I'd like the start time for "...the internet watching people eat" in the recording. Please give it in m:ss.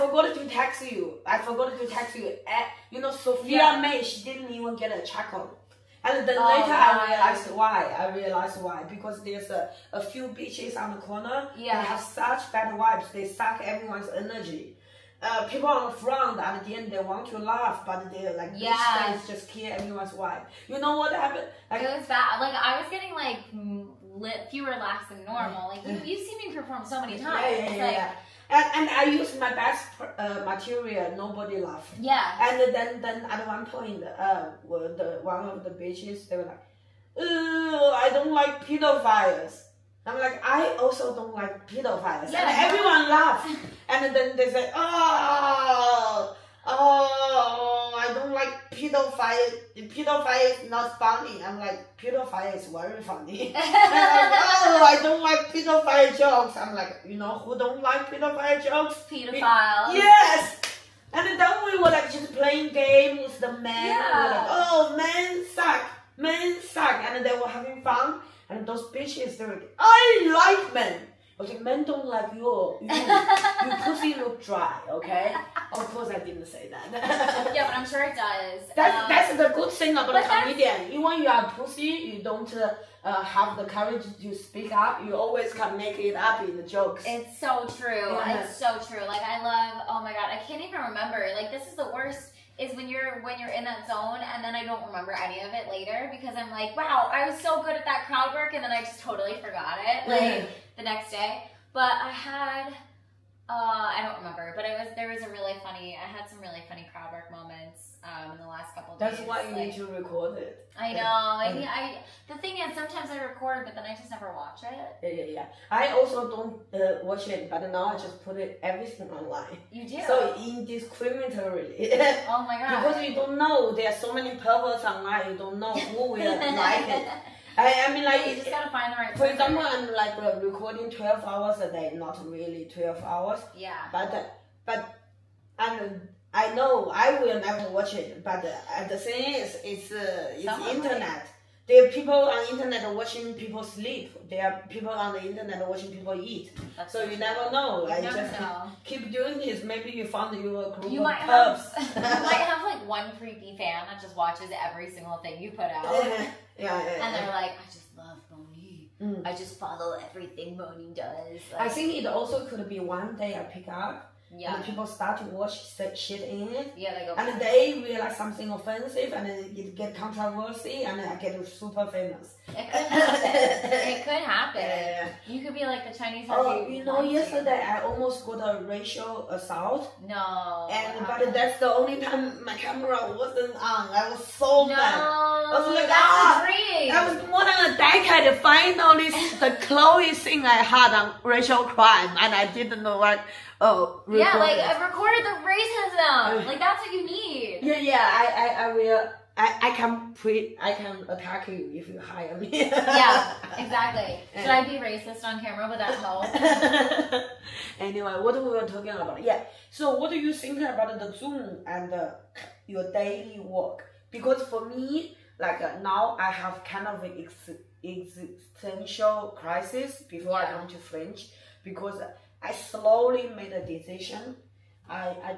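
2:25.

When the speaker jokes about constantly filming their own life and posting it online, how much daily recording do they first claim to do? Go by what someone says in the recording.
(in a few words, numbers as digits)
12 hours a day.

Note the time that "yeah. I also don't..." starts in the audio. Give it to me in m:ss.
1:55.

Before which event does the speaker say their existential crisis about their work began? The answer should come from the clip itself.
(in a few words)
Fringe.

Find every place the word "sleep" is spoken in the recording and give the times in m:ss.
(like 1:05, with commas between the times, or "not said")
2:23.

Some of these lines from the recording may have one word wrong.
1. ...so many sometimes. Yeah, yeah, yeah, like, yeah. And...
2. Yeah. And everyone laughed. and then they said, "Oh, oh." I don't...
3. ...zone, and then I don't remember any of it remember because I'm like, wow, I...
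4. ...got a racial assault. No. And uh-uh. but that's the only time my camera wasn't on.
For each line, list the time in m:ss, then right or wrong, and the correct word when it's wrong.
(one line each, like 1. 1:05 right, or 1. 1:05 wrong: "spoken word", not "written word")
1. 0:26 wrong: "times", not "sometimes"
2. 0:42 right
3. 1:33 wrong: "later", not "remember"
4. 2:58 right.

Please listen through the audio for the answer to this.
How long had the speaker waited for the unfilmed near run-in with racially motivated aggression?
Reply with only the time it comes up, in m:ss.
3:07.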